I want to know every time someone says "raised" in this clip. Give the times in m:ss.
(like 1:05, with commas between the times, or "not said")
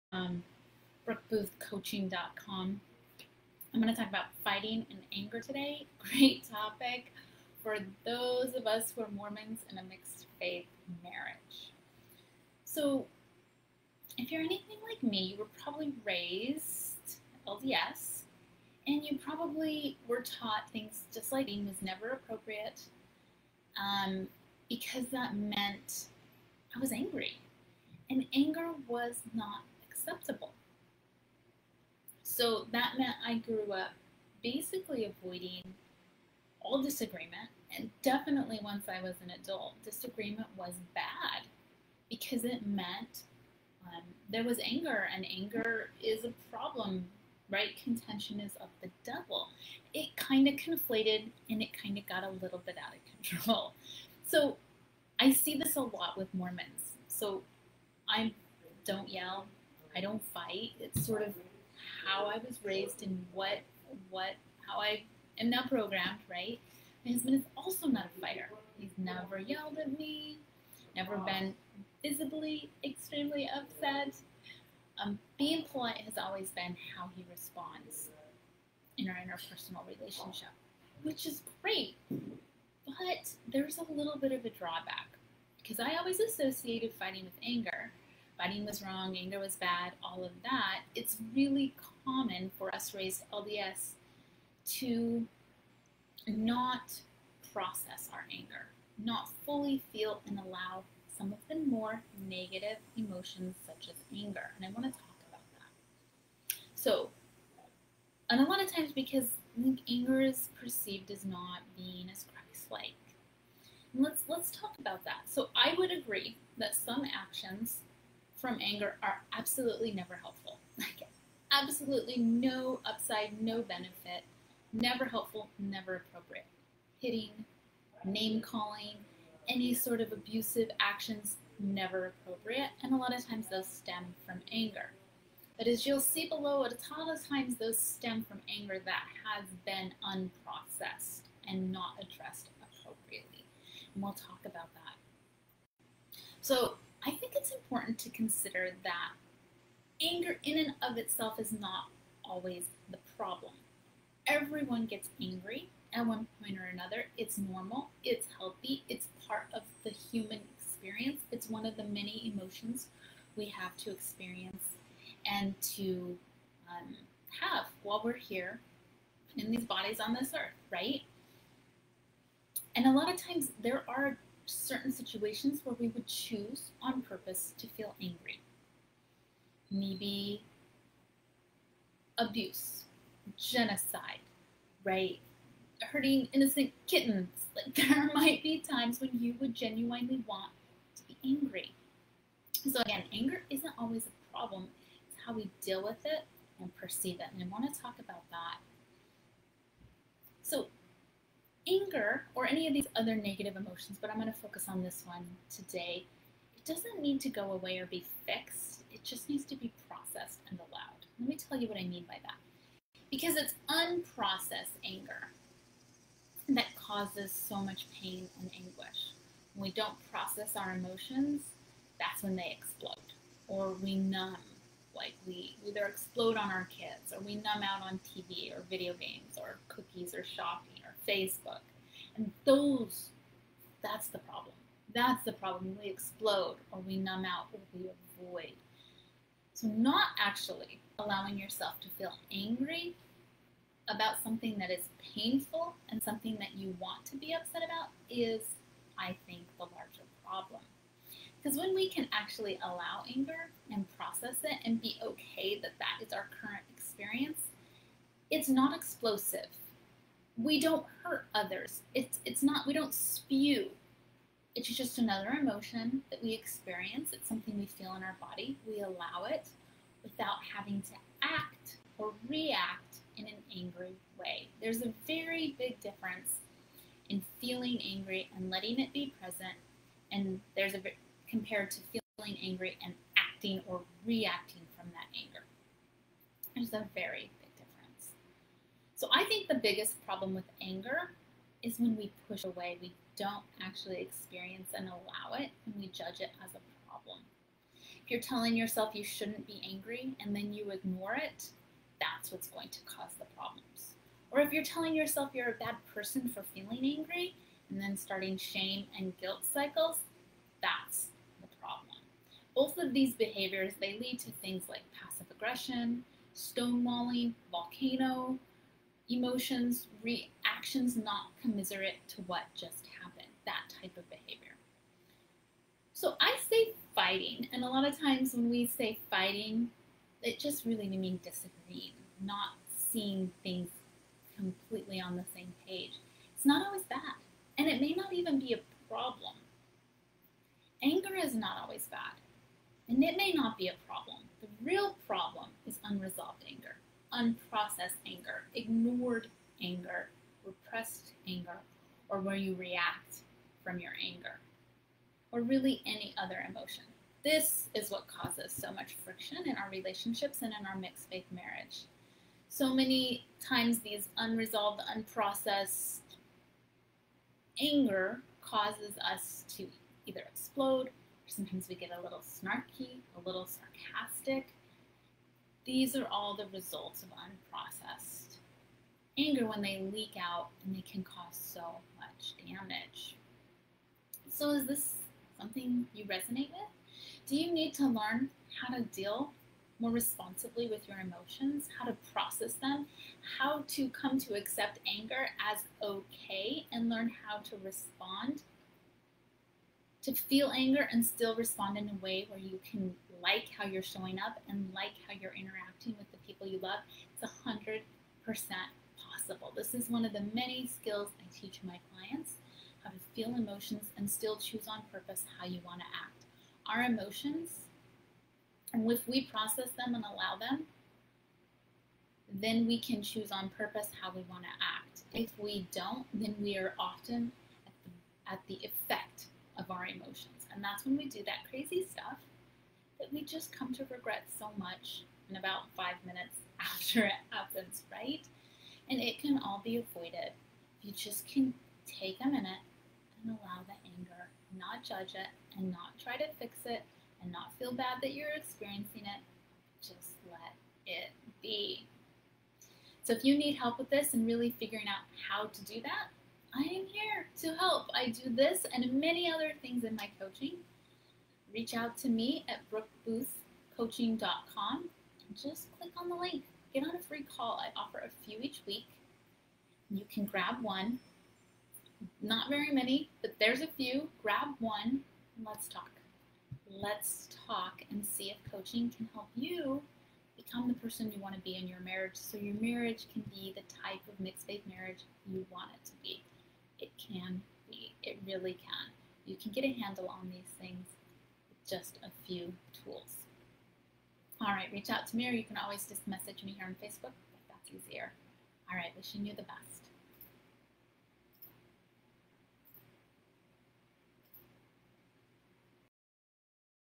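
0:16, 1:02, 1:32.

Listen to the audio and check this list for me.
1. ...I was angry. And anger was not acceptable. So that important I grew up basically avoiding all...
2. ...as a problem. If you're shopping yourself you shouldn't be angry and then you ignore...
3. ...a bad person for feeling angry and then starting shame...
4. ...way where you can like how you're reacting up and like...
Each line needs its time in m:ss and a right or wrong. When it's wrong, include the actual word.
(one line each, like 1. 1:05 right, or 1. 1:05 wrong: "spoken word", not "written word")
1. 0:26 wrong: "meant", not "important"
2. 4:56 wrong: "telling", not "shopping"
3. 5:05 right
4. 6:42 wrong: "showing", not "reacting".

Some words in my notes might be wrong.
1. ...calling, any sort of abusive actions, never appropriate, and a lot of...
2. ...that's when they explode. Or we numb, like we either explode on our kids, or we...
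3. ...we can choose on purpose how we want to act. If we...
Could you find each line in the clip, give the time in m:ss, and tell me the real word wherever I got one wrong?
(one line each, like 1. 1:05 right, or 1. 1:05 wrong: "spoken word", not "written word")
1. 2:08 right
2. 3:41 right
3. 7:02 right.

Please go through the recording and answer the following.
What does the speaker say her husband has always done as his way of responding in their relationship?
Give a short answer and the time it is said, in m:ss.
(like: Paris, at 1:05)
Being polite, at 1:15.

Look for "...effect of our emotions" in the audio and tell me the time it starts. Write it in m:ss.
7:08.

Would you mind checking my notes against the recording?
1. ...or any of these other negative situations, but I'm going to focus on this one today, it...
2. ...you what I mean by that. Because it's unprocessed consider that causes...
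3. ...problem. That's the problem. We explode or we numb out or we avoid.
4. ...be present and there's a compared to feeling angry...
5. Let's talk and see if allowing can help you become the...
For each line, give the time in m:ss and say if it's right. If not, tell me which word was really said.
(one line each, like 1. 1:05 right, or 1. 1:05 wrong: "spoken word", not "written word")
1. 3:22 wrong: "emotions", not "situations"
2. 3:31 wrong: "anger", not "consider"
3. 3:54 right
4. 4:38 right
5. 7:56 wrong: "coaching", not "allowing".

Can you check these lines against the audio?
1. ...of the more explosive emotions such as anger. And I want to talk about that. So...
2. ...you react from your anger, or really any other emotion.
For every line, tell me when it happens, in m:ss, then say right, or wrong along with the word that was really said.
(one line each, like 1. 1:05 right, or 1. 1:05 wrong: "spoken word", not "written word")
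1. 1:41 wrong: "negative", not "explosive"
2. 5:52 right.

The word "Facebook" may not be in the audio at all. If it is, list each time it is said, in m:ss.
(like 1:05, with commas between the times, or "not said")
3:51, 8:16.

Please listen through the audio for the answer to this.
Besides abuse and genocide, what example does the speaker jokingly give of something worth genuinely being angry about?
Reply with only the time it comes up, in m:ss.
3:05.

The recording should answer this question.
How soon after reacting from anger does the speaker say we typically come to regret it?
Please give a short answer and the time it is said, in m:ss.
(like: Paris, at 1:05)
About five minutes, at 7:15.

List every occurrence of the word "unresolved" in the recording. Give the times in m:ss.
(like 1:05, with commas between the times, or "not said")
5:45, 6:04.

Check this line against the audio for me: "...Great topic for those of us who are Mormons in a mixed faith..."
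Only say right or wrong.
right.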